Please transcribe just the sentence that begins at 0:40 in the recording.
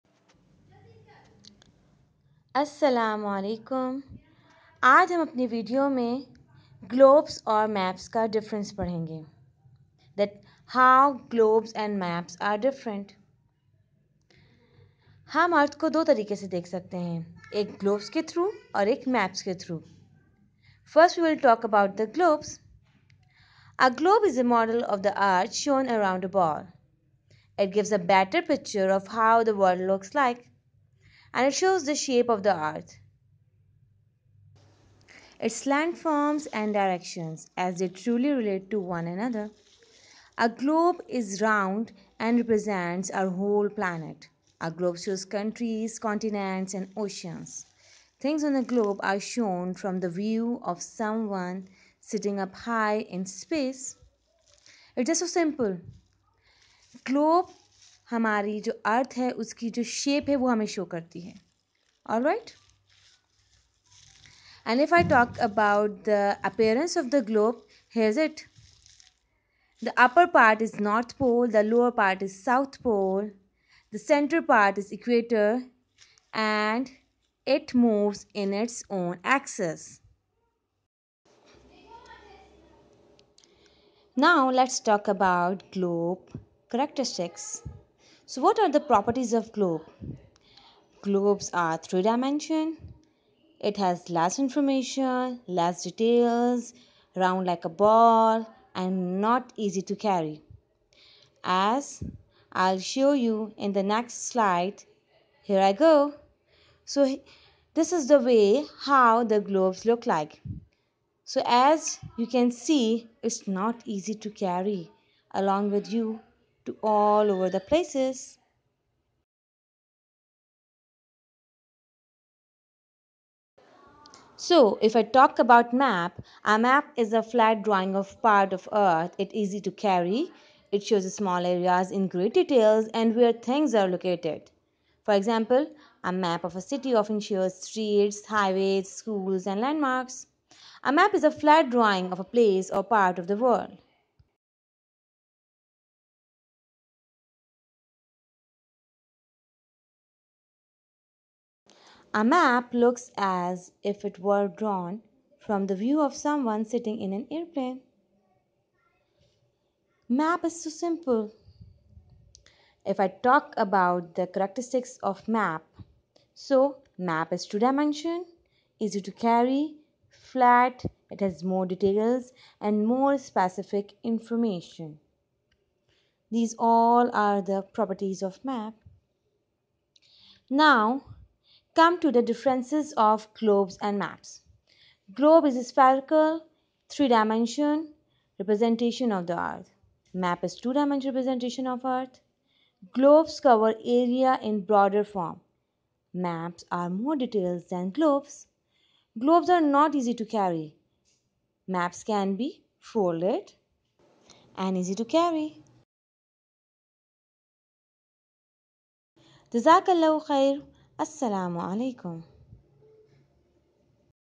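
A globe is round and represents our whole planet.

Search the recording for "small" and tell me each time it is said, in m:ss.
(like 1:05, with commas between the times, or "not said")
2:11.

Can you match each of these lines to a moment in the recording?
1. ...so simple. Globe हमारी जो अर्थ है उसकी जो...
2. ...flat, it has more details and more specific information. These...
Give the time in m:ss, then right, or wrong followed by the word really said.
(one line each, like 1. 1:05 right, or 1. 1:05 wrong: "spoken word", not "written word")
1. 0:55 right
2. 2:50 right.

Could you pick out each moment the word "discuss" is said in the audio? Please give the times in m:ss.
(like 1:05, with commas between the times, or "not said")
not said.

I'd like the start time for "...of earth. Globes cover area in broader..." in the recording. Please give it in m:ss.
3:11.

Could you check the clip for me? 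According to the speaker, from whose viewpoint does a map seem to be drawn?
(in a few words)
someone sitting in an airplane.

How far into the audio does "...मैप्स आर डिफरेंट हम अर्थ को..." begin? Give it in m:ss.
0:12.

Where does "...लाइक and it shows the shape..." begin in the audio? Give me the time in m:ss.
0:30.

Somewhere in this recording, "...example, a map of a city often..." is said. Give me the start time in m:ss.
2:15.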